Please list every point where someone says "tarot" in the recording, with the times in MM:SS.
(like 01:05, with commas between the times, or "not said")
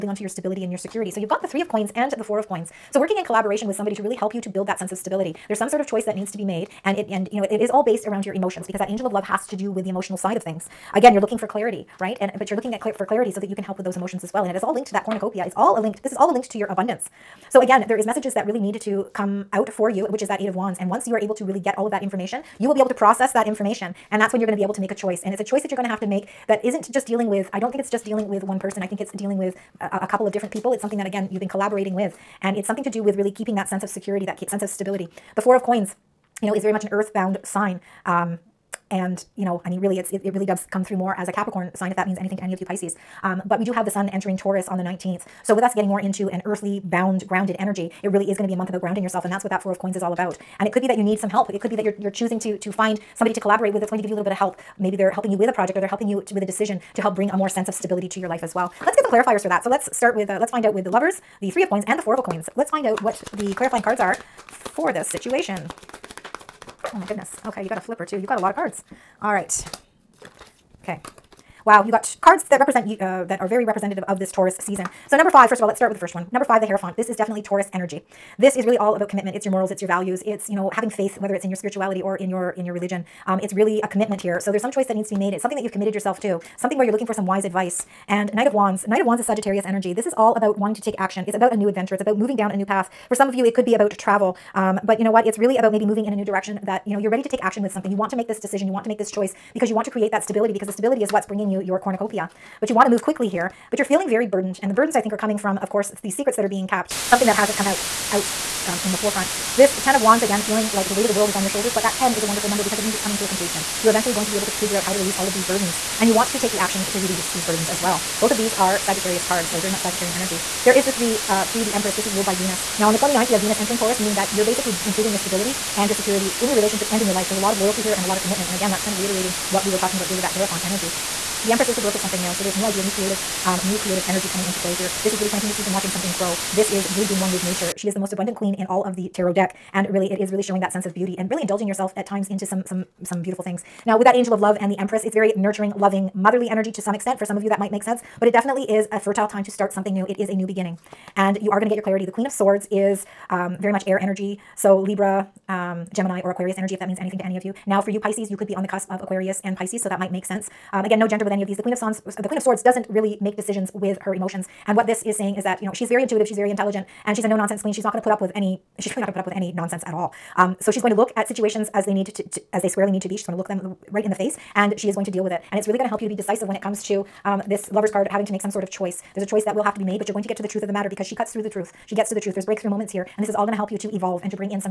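02:19.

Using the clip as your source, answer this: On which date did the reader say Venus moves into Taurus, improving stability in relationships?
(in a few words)
29th.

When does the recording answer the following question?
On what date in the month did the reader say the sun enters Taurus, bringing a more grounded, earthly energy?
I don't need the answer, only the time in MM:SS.
00:44.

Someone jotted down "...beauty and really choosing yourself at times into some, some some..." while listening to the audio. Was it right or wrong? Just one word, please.
wrong.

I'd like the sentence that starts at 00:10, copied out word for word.
Again, you're looking for clarity, right?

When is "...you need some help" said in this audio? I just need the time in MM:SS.
00:50.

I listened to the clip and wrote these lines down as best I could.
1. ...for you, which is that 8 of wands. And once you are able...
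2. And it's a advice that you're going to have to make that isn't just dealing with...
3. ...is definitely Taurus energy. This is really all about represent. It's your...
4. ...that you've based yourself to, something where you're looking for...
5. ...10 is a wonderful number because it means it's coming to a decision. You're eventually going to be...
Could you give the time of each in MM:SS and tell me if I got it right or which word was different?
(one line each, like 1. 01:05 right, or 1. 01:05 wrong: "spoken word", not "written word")
1. 00:19 right
2. 00:25 wrong: "choice", not "advice"
3. 01:17 wrong: "commitment", not "represent"
4. 01:25 wrong: "committed", not "based"
5. 01:51 wrong: "completion", not "decision".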